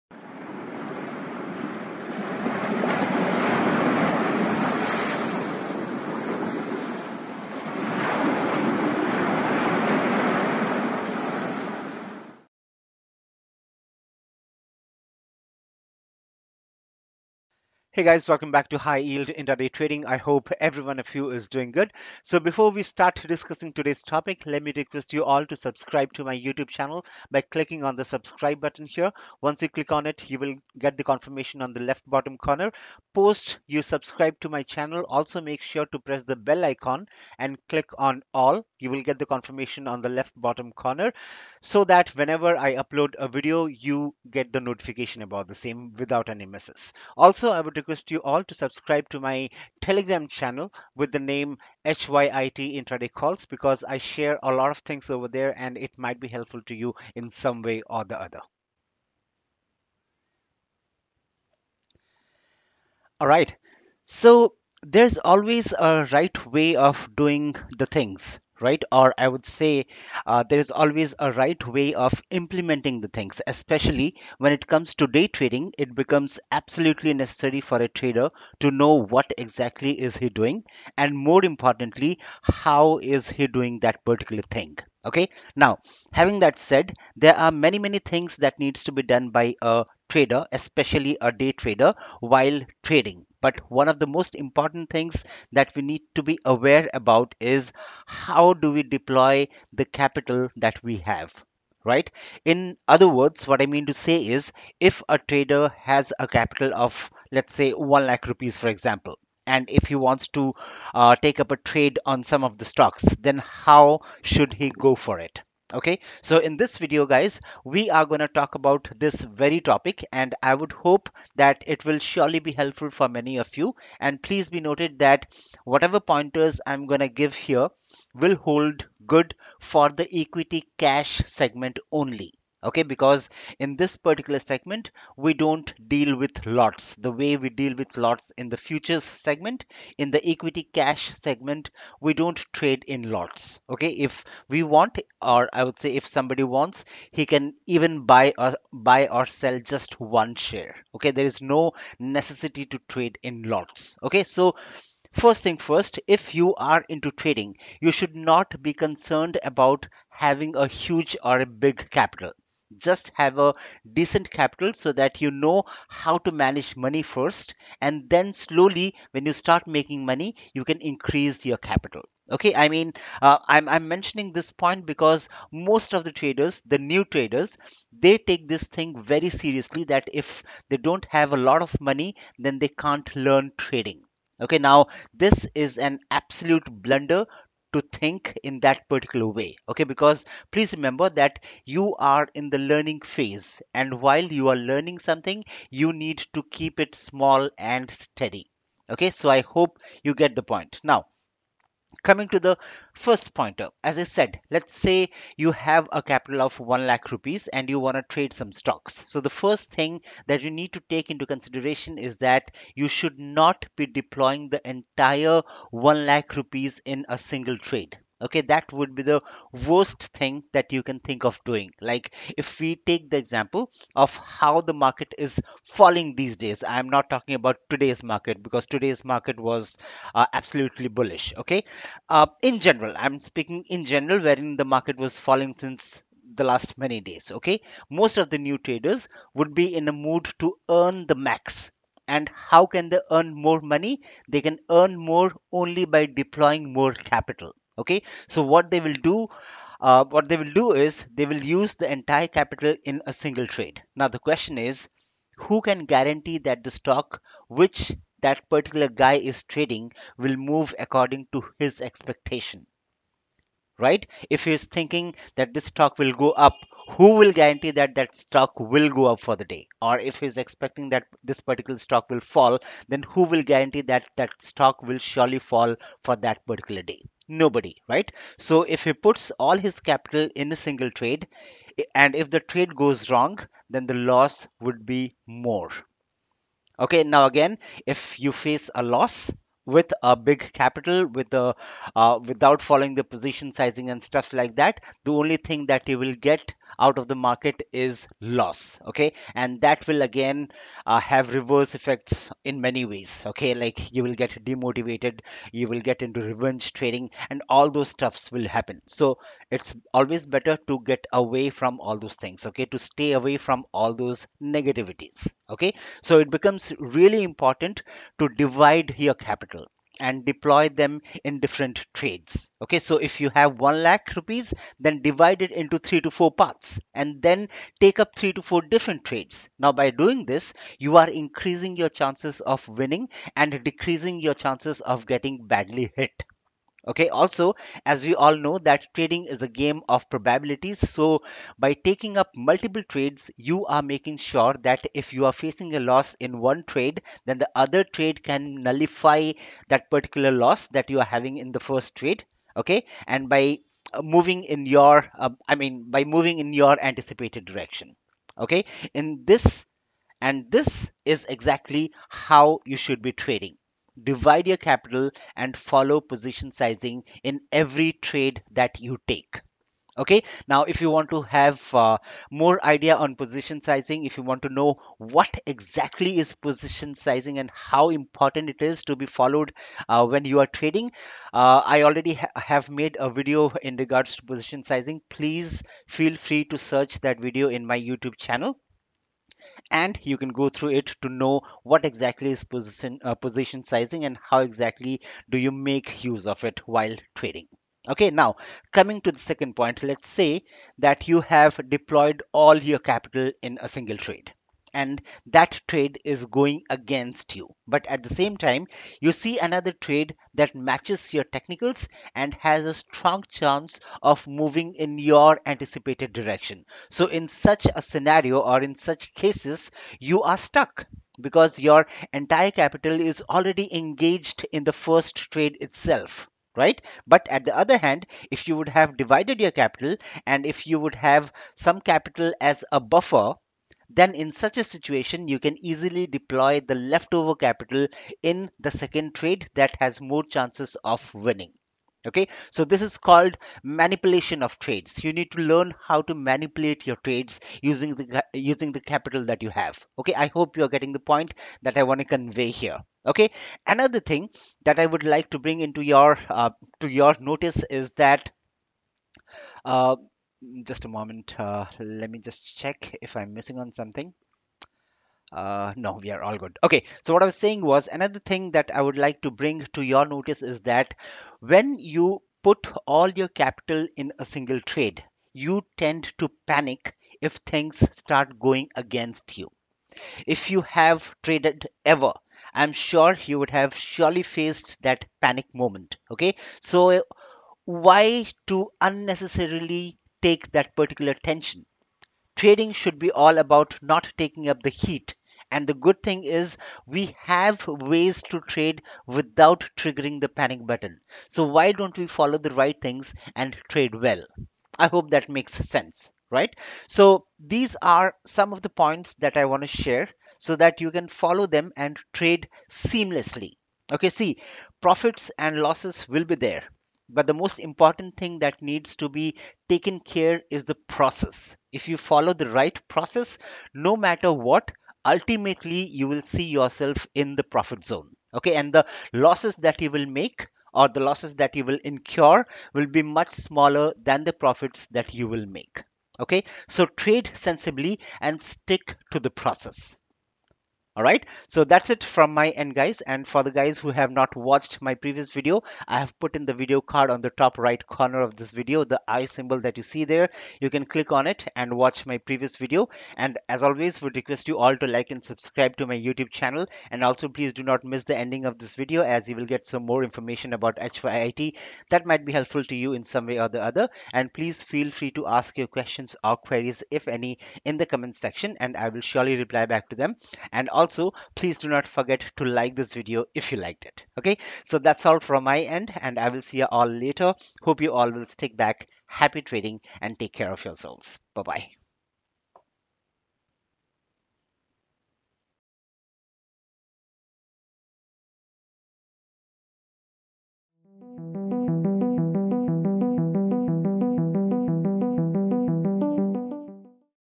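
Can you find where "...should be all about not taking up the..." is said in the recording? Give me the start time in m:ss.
8:12.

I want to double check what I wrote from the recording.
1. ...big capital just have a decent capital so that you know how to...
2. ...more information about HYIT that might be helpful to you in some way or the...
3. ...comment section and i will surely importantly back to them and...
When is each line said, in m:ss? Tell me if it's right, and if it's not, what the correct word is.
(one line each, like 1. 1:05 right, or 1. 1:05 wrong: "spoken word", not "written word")
1. 2:41 right
2. 9:19 right
3. 9:27 wrong: "reply", not "importantly".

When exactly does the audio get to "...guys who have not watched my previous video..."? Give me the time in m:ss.
9:03.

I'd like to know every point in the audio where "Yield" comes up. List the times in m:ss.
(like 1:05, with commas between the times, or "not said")
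0:18.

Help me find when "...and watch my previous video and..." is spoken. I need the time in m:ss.
9:11.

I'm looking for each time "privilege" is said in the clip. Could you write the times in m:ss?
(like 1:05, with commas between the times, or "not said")
not said.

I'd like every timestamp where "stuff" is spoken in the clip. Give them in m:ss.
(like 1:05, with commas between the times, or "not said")
4:54, 5:07.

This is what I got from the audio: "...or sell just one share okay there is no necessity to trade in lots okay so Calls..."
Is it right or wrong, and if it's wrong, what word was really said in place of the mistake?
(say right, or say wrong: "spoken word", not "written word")
wrong: "First", not "Calls".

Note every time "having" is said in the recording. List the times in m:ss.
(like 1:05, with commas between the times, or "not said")
1:26, 2:40, 5:51.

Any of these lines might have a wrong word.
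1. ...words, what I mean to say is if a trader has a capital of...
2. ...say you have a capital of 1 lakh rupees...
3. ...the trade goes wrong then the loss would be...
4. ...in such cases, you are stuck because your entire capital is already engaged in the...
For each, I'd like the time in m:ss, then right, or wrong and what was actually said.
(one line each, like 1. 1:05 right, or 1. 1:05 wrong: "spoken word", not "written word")
1. 1:43 right
2. 3:24 right
3. 4:42 right
4. 6:58 right.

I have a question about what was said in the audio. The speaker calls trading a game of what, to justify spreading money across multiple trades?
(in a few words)
probabilities.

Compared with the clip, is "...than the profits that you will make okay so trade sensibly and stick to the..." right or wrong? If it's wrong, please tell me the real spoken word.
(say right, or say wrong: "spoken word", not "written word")
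right.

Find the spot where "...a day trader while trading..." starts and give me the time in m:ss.
1:31.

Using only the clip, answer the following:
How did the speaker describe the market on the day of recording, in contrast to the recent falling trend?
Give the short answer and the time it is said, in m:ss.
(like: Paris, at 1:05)
absolutely bullish, at 3:50.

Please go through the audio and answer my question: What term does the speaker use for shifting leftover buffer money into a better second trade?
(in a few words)
manipulation of trades.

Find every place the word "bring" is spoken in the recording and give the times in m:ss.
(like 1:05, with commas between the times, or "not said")
7:35, 7:49.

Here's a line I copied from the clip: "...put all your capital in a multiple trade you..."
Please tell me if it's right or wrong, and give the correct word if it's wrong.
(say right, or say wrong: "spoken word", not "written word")
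wrong: "single", not "multiple".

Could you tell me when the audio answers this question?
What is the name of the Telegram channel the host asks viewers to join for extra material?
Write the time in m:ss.
0:51.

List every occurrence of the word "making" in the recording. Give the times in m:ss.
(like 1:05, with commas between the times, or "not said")
2:49, 5:43.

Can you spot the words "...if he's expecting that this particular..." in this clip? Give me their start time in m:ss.
4:29.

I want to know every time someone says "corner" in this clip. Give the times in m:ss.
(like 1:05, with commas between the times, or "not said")
0:32, 0:40, 9:07.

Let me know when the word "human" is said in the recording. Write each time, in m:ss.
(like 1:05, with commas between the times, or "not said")
not said.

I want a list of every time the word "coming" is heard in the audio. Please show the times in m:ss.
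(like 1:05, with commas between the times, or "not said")
3:22, 6:38.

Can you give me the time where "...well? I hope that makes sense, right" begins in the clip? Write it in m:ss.
8:23.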